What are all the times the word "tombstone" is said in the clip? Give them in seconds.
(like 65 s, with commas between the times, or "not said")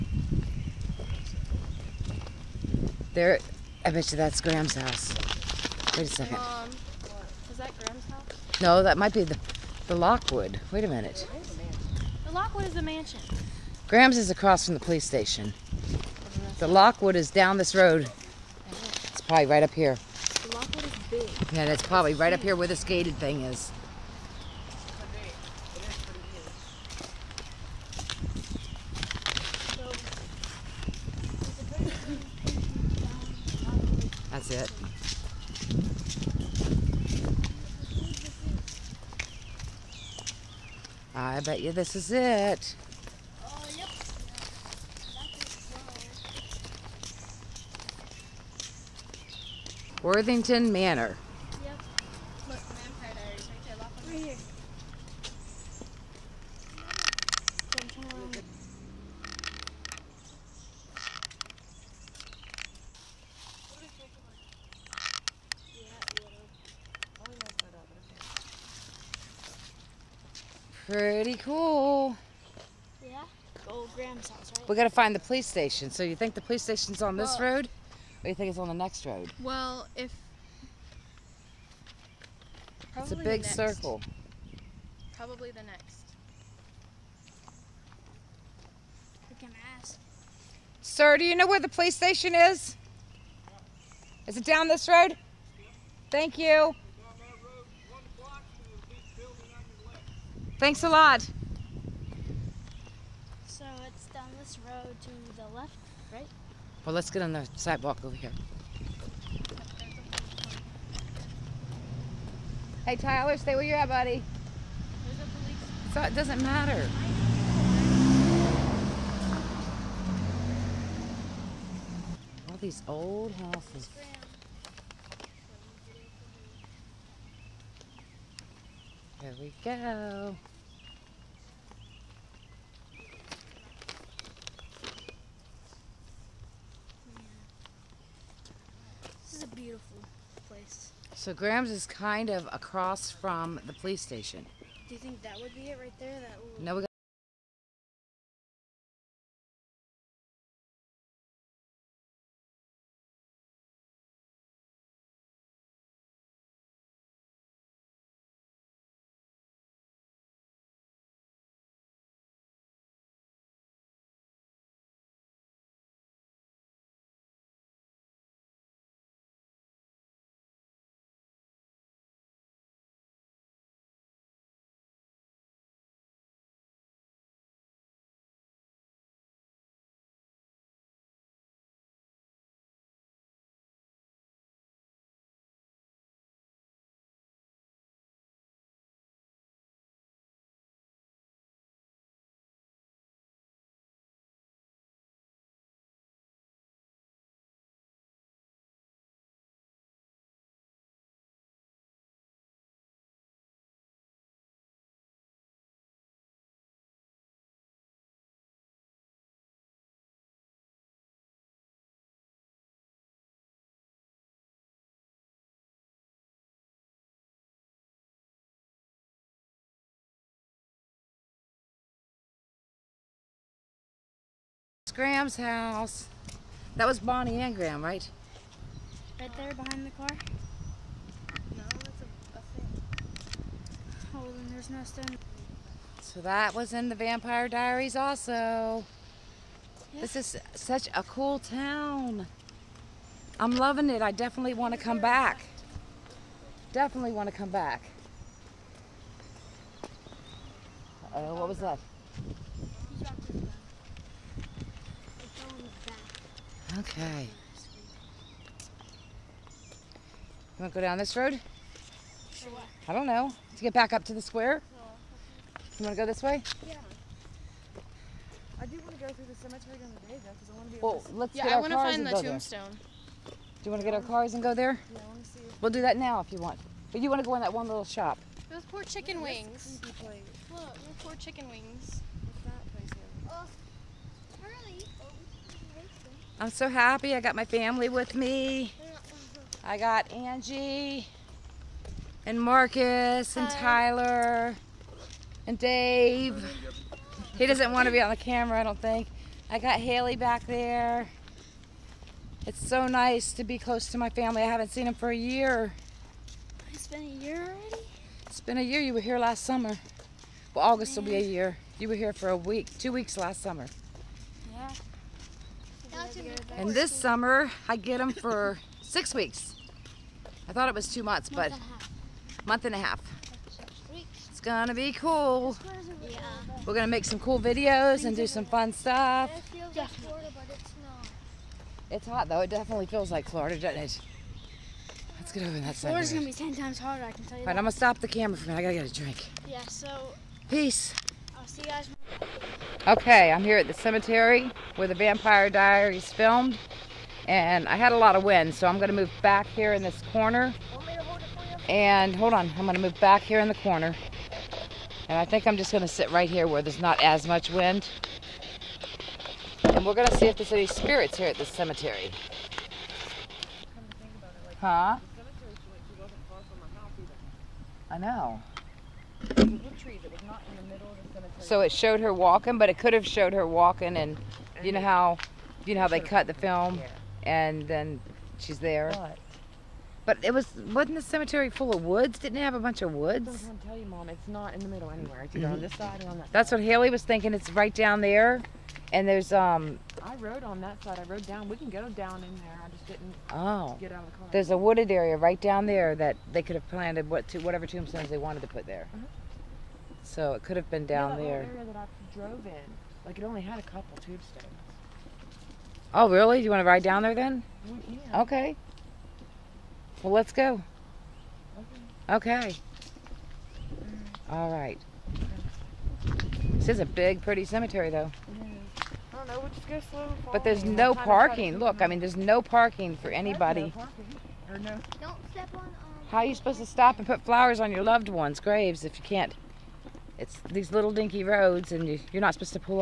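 272 s, 397 s.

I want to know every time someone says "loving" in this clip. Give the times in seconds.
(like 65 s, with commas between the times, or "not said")
243 s.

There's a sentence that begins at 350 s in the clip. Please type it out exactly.
Hold and hold on, I'm gonna move back here in the corner.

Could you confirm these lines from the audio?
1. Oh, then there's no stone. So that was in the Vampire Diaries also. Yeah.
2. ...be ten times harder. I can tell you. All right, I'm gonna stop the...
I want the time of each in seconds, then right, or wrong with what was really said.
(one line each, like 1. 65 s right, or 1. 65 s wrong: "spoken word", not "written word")
1. 234 s right
2. 336 s right.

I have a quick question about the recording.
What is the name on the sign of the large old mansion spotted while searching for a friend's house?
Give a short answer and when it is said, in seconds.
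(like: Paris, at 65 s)
Worthington Manor, at 50 s.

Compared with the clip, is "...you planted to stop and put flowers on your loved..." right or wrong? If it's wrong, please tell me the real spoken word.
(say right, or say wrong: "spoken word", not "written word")
wrong: "supposed", not "planted".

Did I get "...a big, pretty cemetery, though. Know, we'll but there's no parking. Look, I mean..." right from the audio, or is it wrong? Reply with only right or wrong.
right.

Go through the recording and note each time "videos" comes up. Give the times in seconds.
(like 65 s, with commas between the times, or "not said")
327 s.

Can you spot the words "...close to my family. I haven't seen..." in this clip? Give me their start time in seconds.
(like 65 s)
303 s.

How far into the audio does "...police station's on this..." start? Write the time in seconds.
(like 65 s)
76 s.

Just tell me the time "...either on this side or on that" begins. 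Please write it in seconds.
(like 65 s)
385 s.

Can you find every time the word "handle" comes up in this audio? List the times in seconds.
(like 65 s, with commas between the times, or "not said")
not said.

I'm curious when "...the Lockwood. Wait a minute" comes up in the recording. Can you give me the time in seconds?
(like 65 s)
9 s.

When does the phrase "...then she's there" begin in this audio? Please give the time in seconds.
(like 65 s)
377 s.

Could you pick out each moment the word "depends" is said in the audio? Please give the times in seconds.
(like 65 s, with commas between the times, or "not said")
not said.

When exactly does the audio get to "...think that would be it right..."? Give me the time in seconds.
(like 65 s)
145 s.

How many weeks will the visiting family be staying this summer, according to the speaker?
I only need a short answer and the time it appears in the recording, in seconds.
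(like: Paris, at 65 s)
6, at 318 s.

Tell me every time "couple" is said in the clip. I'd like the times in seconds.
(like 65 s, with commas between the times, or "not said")
403 s.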